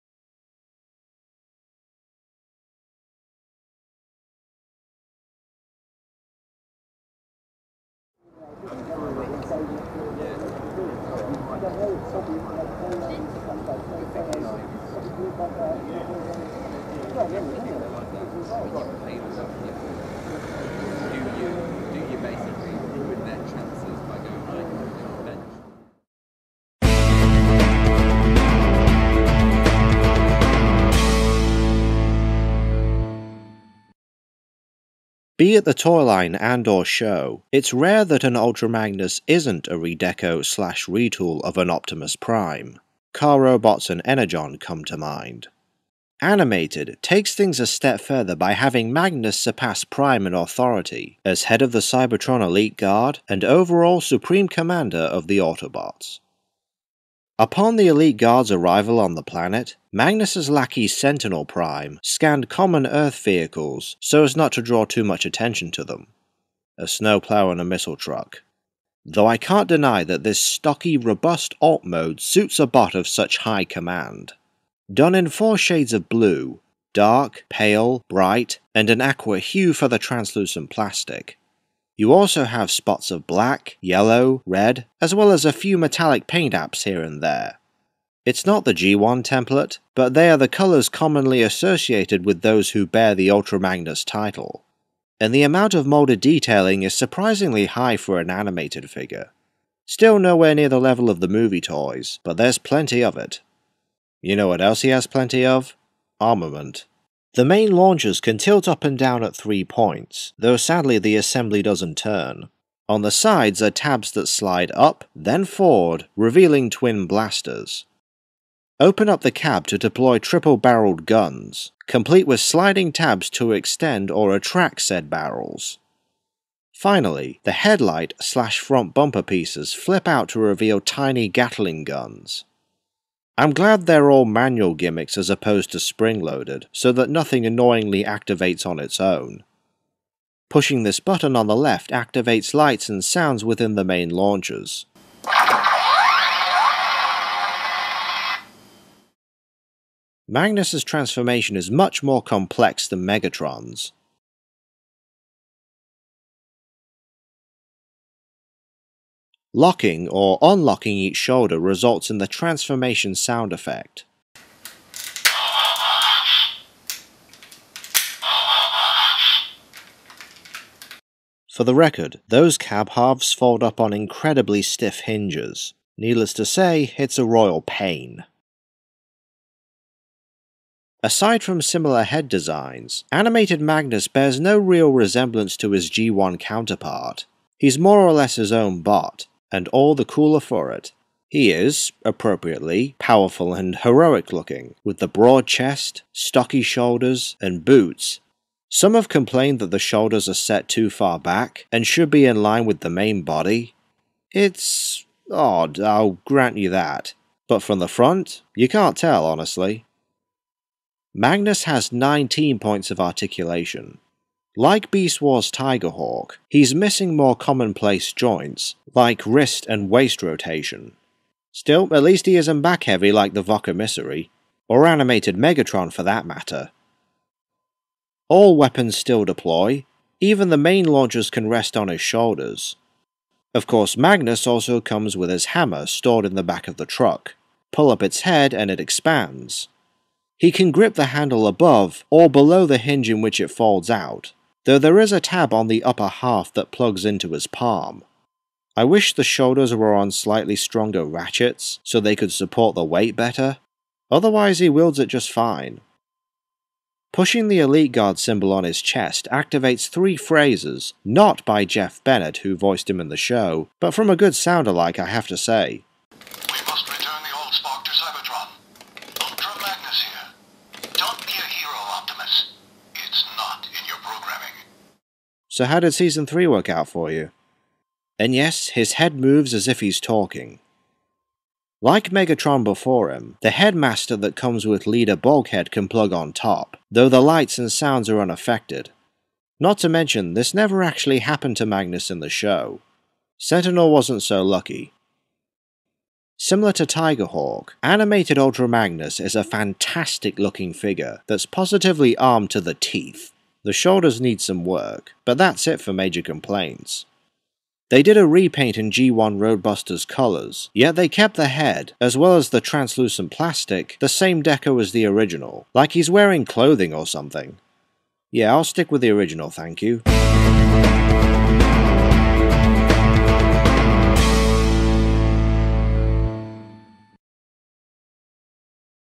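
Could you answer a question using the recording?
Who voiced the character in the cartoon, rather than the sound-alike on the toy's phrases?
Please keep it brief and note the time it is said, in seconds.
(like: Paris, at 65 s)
Jeff Bennett, at 261 s.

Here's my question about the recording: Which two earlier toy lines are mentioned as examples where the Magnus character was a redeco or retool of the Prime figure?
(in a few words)
Car Robots and Energon.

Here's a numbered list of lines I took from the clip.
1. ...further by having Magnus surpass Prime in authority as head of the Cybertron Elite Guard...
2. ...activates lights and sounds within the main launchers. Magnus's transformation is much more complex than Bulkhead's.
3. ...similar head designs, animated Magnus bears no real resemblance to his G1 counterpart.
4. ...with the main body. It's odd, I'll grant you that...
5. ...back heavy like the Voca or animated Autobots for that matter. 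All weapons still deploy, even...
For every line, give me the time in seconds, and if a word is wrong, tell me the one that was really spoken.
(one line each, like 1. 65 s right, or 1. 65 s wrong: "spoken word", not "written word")
1. 48 s right
2. 141 s wrong: "Megatron", not "Bulkhead"
3. 181 s right
4. 202 s right
5. 222 s wrong: "Megatron", not "Autobots".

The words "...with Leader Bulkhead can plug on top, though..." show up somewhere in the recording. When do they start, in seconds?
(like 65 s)
284 s.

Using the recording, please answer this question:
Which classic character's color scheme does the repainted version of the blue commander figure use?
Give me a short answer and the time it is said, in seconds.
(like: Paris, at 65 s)
G1 Roadbuster, at 308 s.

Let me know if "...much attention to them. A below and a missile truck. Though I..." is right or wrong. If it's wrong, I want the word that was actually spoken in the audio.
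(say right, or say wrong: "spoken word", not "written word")
wrong: "snowplow", not "below".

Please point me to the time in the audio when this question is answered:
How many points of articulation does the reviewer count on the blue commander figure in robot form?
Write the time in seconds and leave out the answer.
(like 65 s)
211 s.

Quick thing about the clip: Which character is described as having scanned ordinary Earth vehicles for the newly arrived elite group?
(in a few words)
Sentinel Prime.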